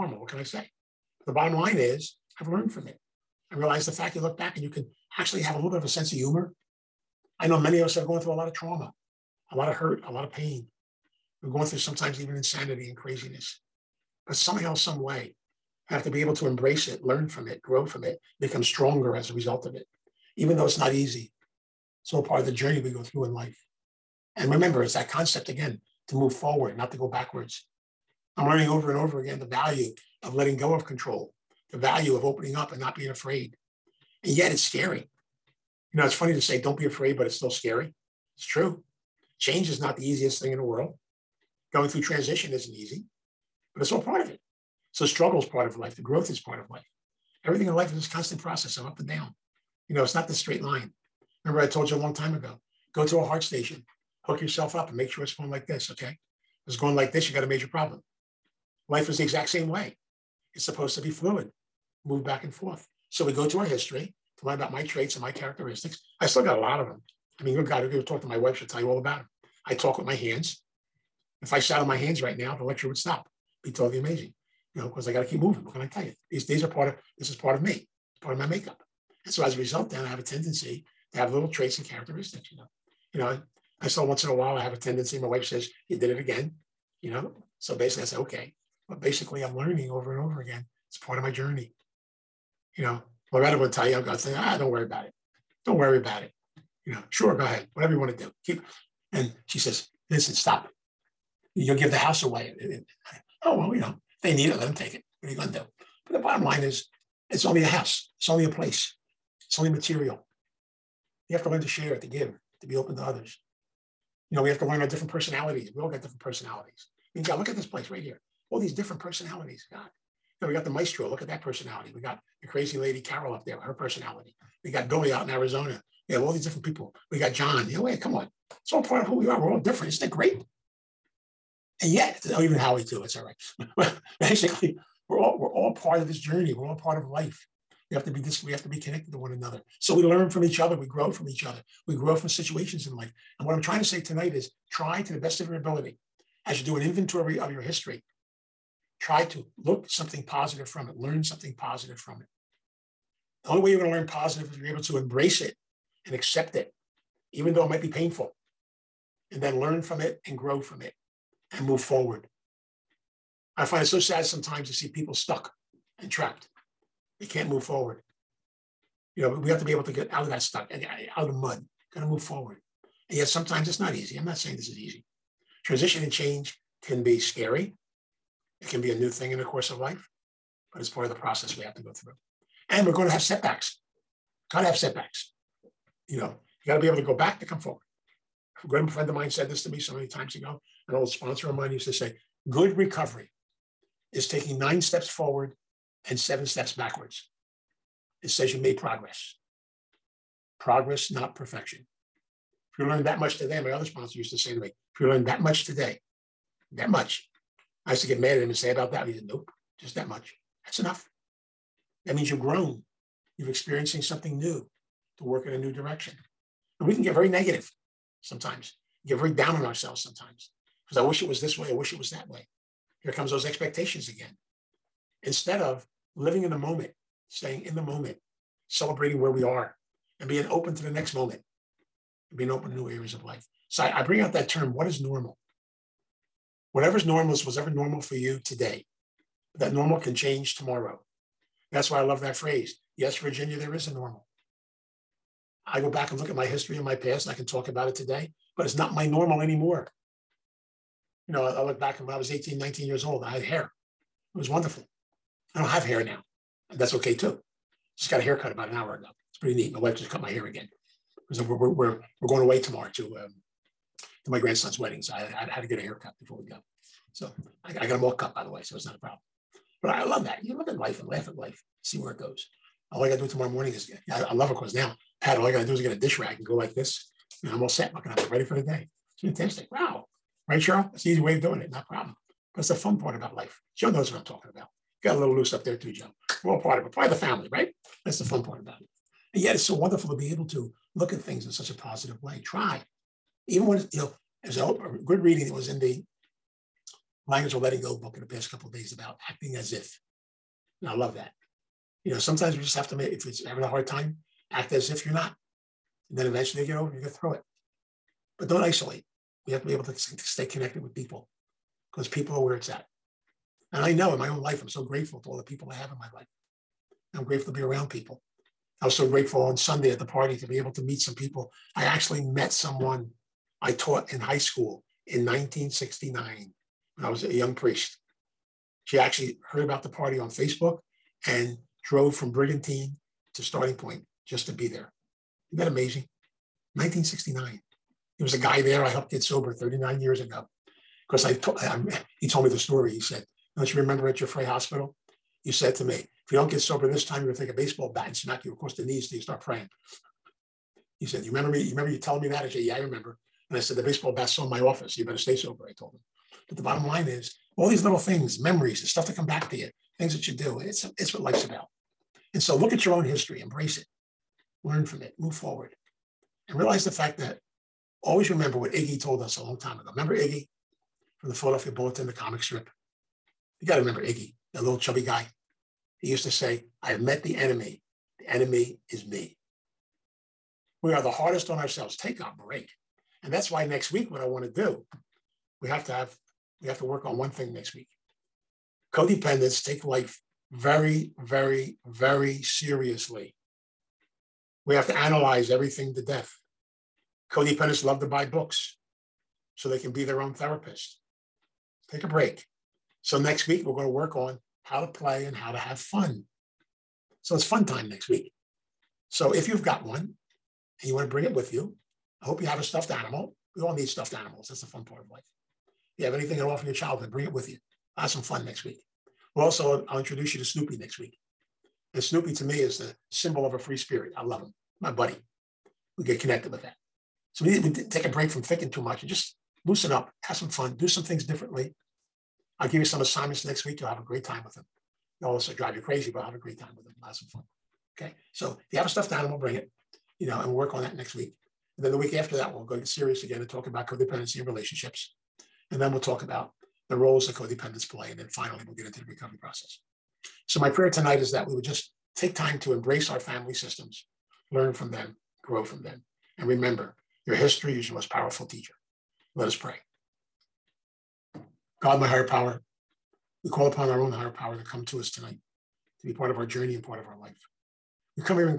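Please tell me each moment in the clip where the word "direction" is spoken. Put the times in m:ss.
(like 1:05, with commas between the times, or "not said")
3:35.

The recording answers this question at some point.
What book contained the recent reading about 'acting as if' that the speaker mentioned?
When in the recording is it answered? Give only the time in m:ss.
4:57.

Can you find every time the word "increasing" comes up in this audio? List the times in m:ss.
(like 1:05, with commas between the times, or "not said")
not said.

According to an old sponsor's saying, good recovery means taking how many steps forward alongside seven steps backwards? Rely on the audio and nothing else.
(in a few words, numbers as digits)
9.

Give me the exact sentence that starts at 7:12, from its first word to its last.
I'll give you some assignments next week.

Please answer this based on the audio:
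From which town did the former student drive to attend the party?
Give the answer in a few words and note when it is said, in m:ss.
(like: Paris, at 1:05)
Brigantine, at 5:32.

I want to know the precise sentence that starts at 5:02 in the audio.
You know, sometimes we just have to make, if it's having a hard time, act as if you're not.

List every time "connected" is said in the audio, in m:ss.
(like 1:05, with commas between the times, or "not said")
2:18, 5:10, 7:06.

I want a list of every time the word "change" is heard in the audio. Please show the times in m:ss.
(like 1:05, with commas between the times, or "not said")
0:39, 2:56, 4:00.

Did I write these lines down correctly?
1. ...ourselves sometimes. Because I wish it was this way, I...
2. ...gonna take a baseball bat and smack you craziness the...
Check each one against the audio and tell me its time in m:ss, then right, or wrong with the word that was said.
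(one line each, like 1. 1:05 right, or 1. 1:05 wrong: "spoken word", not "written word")
1. 3:39 right
2. 5:47 wrong: "across", not "craziness".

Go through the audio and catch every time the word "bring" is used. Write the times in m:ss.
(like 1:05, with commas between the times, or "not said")
3:54, 6:51, 6:57, 7:19.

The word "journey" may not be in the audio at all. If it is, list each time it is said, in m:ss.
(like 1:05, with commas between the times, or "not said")
0:22, 1:31, 2:16, 7:46.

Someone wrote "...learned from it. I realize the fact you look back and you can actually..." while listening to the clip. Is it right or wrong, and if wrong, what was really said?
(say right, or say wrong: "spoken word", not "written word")
right.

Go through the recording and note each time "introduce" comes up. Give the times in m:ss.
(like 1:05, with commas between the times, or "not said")
6:59.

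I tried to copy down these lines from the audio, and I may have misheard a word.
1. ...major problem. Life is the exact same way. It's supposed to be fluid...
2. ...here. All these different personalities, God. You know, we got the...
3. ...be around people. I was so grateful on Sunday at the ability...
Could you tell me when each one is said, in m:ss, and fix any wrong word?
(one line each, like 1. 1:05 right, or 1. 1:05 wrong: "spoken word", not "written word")
1. 0:57 right
2. 1:58 right
3. 5:17 wrong: "party", not "ability".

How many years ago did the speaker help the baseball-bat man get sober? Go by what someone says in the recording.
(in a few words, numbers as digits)
39.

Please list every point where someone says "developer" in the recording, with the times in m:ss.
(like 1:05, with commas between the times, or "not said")
not said.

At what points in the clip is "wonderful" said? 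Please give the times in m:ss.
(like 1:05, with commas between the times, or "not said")
4:14, 4:49.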